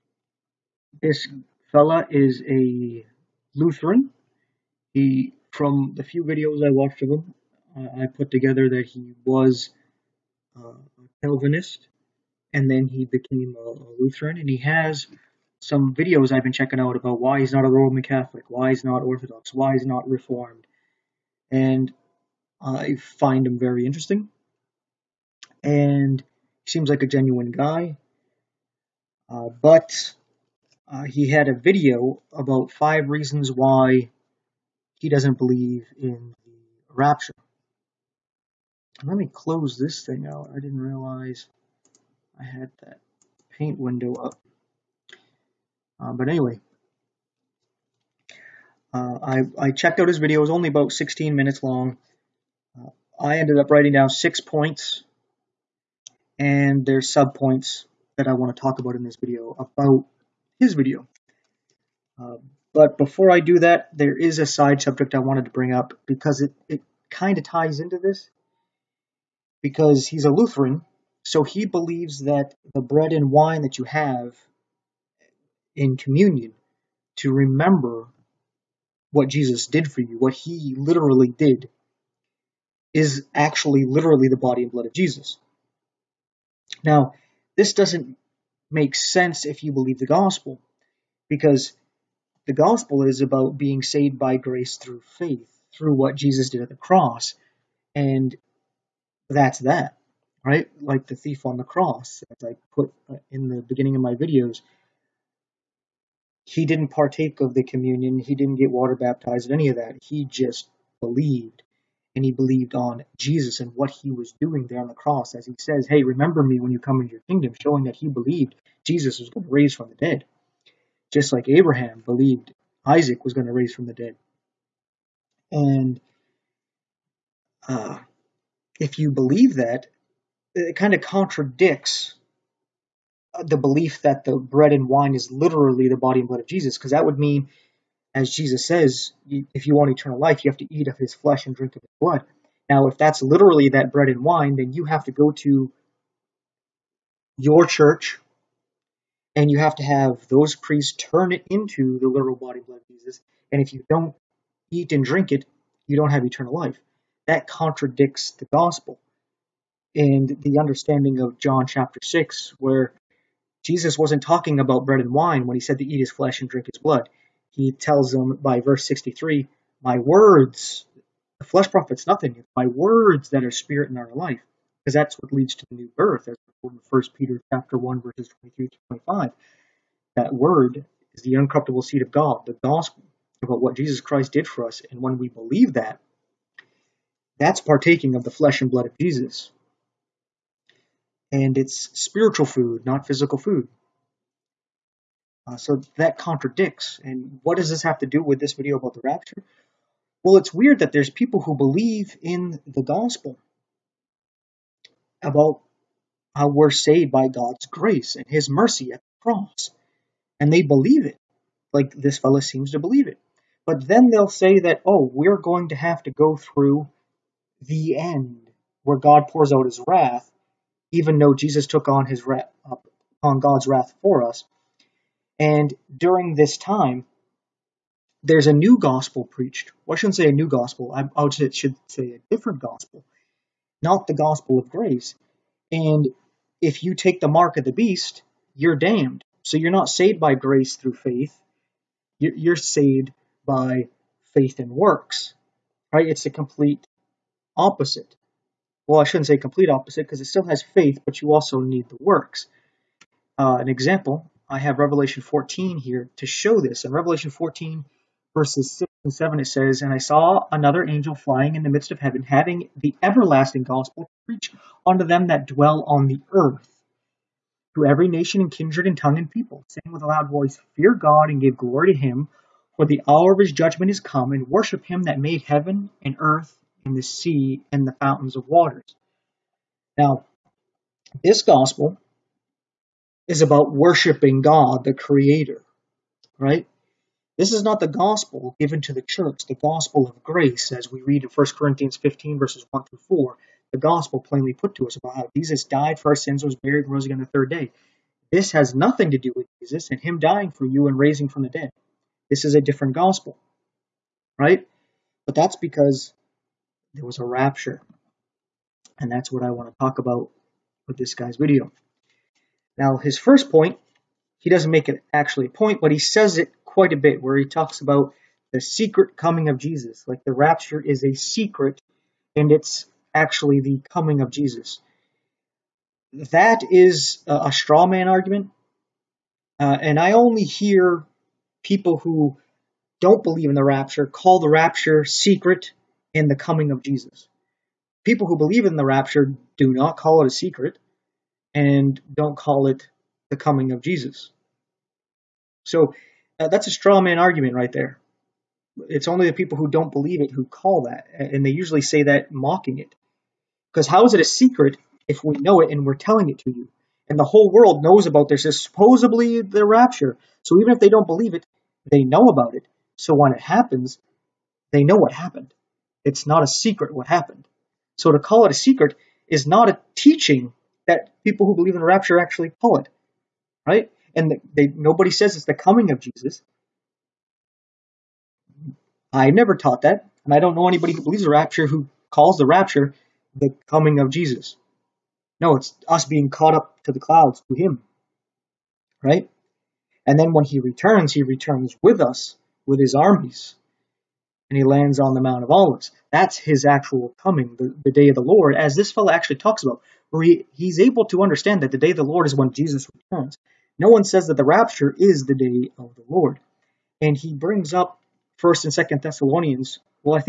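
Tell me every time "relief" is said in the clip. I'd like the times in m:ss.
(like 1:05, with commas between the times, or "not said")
not said.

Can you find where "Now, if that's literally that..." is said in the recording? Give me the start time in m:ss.
2:22.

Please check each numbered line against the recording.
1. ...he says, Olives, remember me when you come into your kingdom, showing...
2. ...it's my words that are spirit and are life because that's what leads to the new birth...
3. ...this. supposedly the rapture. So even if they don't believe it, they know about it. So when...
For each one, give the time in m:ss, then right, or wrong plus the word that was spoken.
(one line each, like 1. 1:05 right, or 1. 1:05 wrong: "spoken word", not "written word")
1. 1:55 wrong: "Hey", not "Olives"
2. 2:52 right
3. 5:58 right.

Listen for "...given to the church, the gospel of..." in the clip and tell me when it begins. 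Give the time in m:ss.
4:48.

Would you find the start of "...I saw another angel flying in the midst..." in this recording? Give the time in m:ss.
4:19.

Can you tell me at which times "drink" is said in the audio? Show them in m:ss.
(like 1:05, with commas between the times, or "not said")
2:21, 2:35, 2:46.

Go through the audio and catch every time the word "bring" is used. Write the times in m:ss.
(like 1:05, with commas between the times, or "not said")
1:05, 6:47.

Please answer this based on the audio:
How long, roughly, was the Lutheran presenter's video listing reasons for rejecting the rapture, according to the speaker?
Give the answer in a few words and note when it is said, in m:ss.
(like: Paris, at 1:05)
16 minutes, at 0:50.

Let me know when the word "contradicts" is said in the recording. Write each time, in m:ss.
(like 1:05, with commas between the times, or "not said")
2:11, 2:37, 3:16.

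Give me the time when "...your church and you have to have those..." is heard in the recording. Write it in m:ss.
2:27.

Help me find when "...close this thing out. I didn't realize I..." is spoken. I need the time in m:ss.
0:39.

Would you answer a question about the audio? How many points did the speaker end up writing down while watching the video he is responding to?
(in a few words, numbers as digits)
six.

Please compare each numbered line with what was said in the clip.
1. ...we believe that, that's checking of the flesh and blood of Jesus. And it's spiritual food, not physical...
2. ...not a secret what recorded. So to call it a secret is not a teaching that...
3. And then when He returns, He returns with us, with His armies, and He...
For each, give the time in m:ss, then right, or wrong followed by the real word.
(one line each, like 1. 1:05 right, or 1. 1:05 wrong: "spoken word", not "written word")
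1. 3:05 wrong: "partaking", not "checking"
2. 6:06 wrong: "happened", not "recorded"
3. 6:30 right.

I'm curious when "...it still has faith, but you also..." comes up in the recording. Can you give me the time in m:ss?
4:10.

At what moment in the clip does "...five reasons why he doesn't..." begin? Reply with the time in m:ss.
0:32.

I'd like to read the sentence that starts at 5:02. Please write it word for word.
This is a different gospel, right?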